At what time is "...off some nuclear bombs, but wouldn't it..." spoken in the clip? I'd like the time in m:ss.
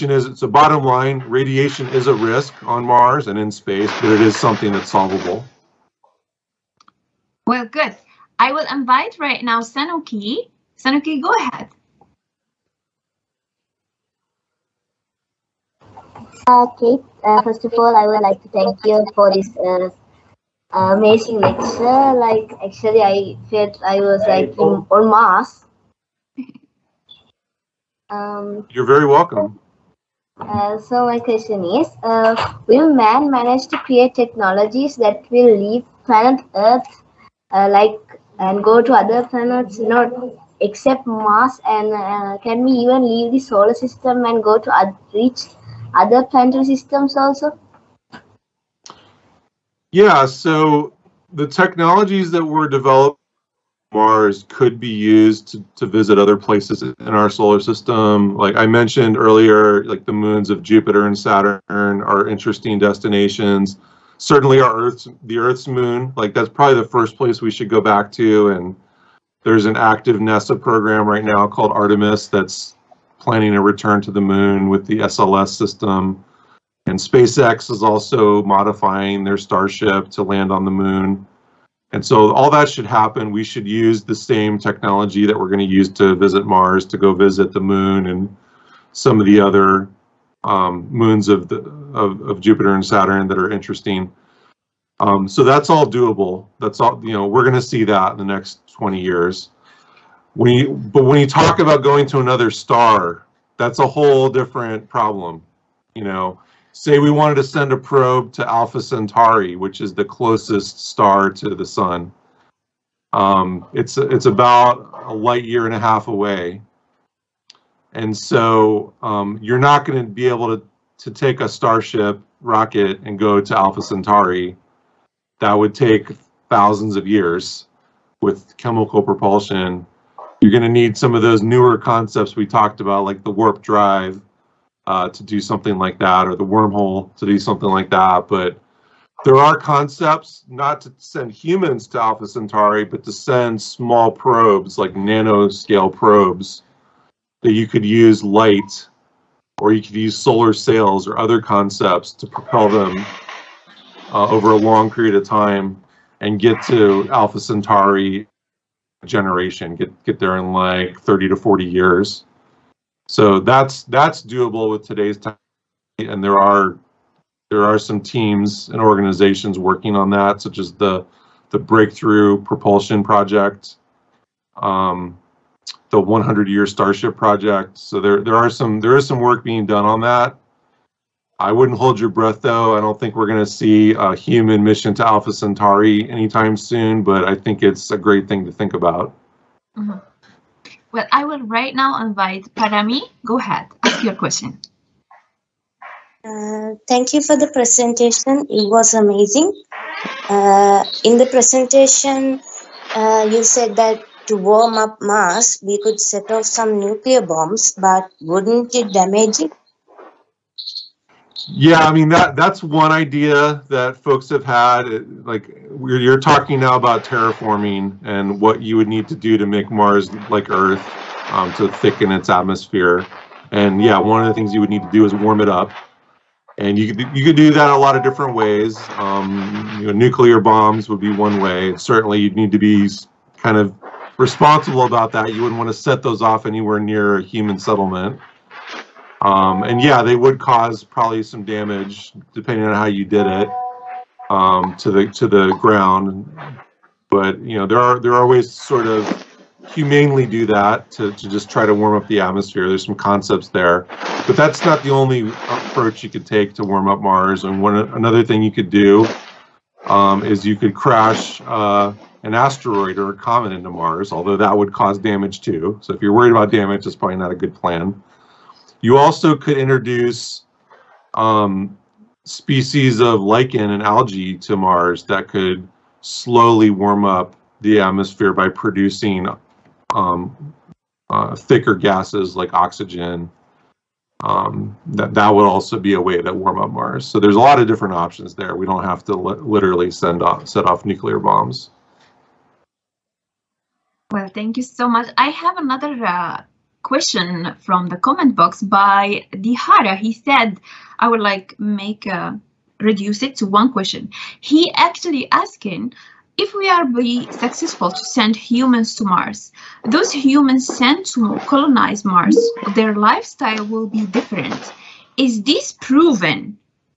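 3:26.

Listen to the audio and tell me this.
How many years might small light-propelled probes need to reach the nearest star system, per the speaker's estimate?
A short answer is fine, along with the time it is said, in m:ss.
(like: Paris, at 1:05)
30 to 40 years, at 2:41.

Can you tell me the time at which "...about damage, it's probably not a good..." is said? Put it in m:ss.
4:26.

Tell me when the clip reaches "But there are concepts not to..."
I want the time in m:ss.
2:18.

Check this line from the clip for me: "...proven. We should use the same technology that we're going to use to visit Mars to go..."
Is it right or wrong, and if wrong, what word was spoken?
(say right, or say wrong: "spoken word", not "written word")
wrong: "happen", not "proven".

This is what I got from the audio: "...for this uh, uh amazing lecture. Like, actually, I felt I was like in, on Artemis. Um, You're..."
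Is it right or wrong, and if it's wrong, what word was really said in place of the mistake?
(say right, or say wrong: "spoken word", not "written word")
wrong: "Mars", not "Artemis".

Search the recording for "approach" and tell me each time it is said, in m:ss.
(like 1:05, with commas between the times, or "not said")
4:15.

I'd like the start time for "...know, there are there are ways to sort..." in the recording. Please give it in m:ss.
4:07.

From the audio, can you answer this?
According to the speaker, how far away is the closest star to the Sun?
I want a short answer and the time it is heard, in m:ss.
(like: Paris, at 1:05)
a light year and a half, at 1:55.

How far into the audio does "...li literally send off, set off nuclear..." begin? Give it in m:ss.
4:49.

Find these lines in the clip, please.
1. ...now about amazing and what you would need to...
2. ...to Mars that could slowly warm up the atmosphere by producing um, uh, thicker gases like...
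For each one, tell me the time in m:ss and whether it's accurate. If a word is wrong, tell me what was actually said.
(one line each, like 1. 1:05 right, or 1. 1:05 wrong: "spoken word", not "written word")
1. 3:36 wrong: "terraforming", not "amazing"
2. 4:34 right.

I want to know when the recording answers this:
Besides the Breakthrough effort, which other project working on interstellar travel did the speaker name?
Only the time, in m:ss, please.
2:56.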